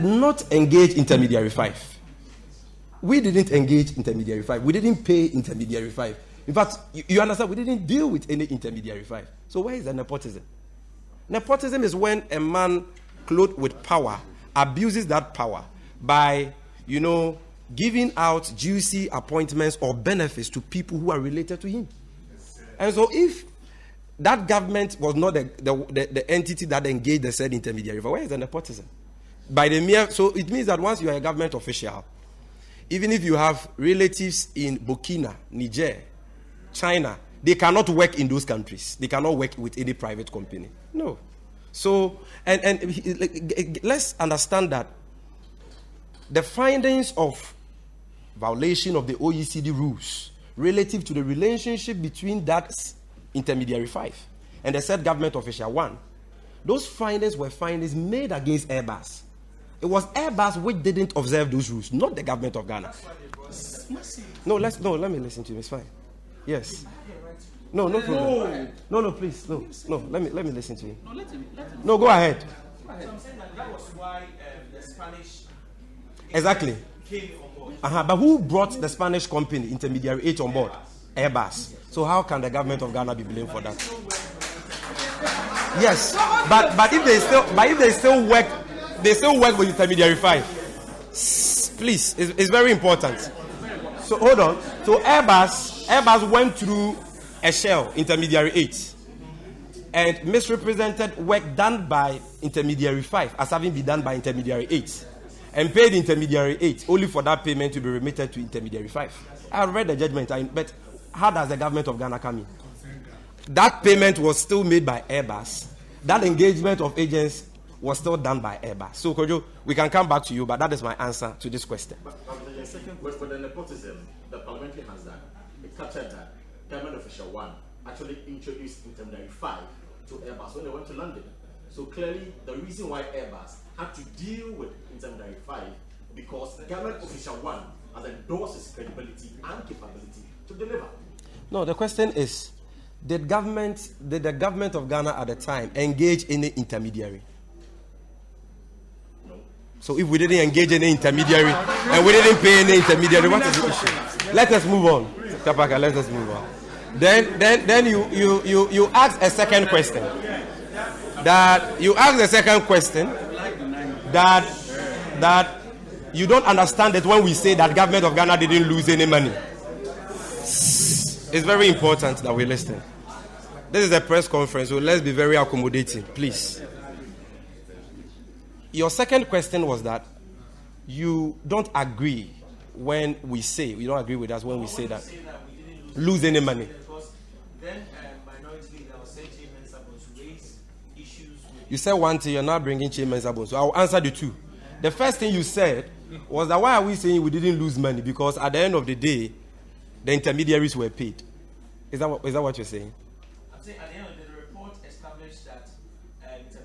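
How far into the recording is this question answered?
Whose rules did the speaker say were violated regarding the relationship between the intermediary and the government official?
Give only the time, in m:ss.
0:49.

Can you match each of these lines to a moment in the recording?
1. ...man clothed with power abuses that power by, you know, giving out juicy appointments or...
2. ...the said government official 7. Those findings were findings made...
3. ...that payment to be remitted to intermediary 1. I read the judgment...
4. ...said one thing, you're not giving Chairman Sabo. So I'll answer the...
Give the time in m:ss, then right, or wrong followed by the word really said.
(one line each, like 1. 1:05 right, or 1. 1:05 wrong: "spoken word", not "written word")
1. 0:12 right
2. 0:54 wrong: "1", not "7"
3. 1:47 wrong: "5", not "1"
4. 3:11 wrong: "bringing", not "giving".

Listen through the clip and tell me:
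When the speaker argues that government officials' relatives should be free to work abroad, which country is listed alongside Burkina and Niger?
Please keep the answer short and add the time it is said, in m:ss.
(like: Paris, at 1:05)
China, at 0:36.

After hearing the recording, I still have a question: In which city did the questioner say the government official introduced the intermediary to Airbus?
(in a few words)
London.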